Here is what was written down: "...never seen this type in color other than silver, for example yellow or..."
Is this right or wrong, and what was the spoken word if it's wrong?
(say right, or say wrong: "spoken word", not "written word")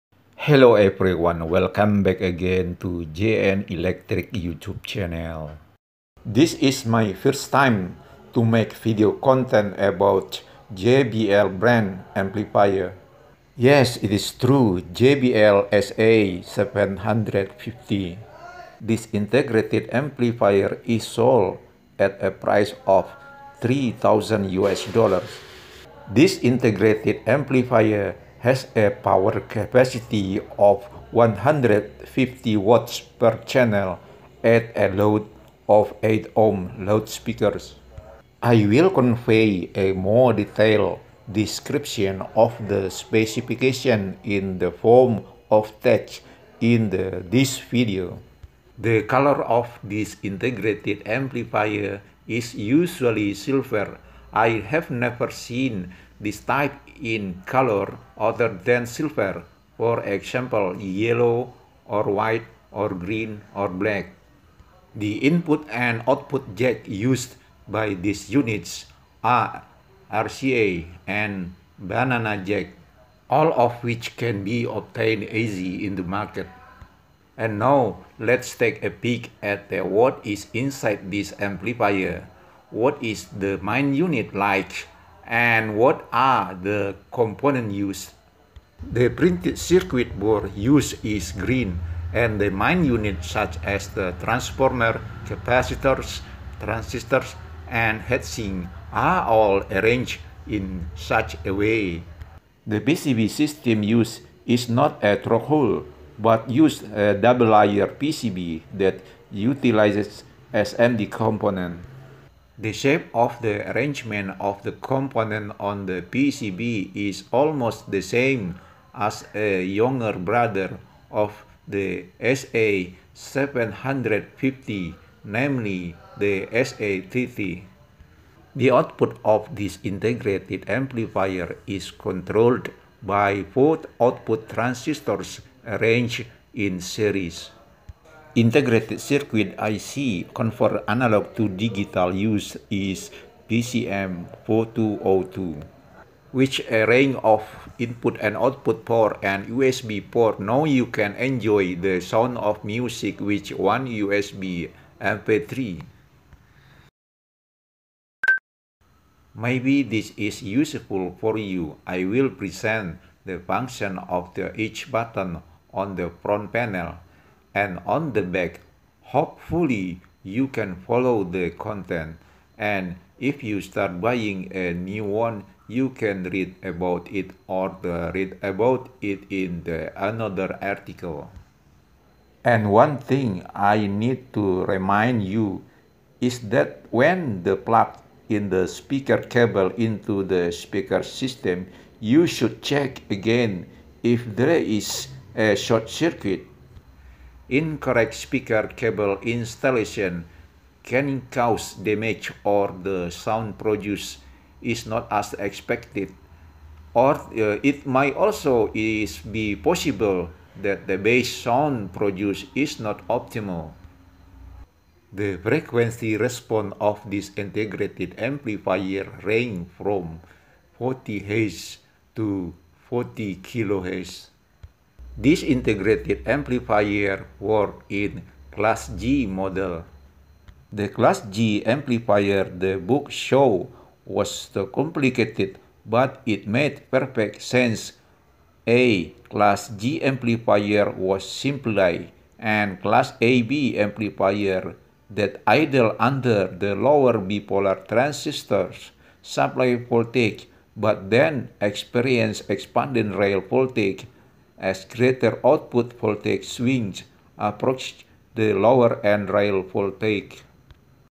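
right.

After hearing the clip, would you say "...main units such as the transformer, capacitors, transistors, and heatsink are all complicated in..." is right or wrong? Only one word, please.
wrong.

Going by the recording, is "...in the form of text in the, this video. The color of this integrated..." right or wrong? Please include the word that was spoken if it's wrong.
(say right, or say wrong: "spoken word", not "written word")
right.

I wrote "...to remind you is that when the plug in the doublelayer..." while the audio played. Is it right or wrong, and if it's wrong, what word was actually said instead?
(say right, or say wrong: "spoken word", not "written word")
wrong: "speaker", not "doublelayer".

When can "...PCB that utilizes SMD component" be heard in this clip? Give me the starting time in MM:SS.
01:47.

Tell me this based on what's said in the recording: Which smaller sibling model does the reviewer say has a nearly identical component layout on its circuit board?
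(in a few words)
SA30.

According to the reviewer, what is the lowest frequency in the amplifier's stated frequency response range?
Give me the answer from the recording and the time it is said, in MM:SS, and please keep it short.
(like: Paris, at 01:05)
40 Hz, at 03:40.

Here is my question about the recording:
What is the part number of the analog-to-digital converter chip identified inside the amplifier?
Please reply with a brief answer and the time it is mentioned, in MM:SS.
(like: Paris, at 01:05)
PCM4202, at 02:23.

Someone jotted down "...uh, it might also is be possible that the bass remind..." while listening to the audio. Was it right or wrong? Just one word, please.
wrong.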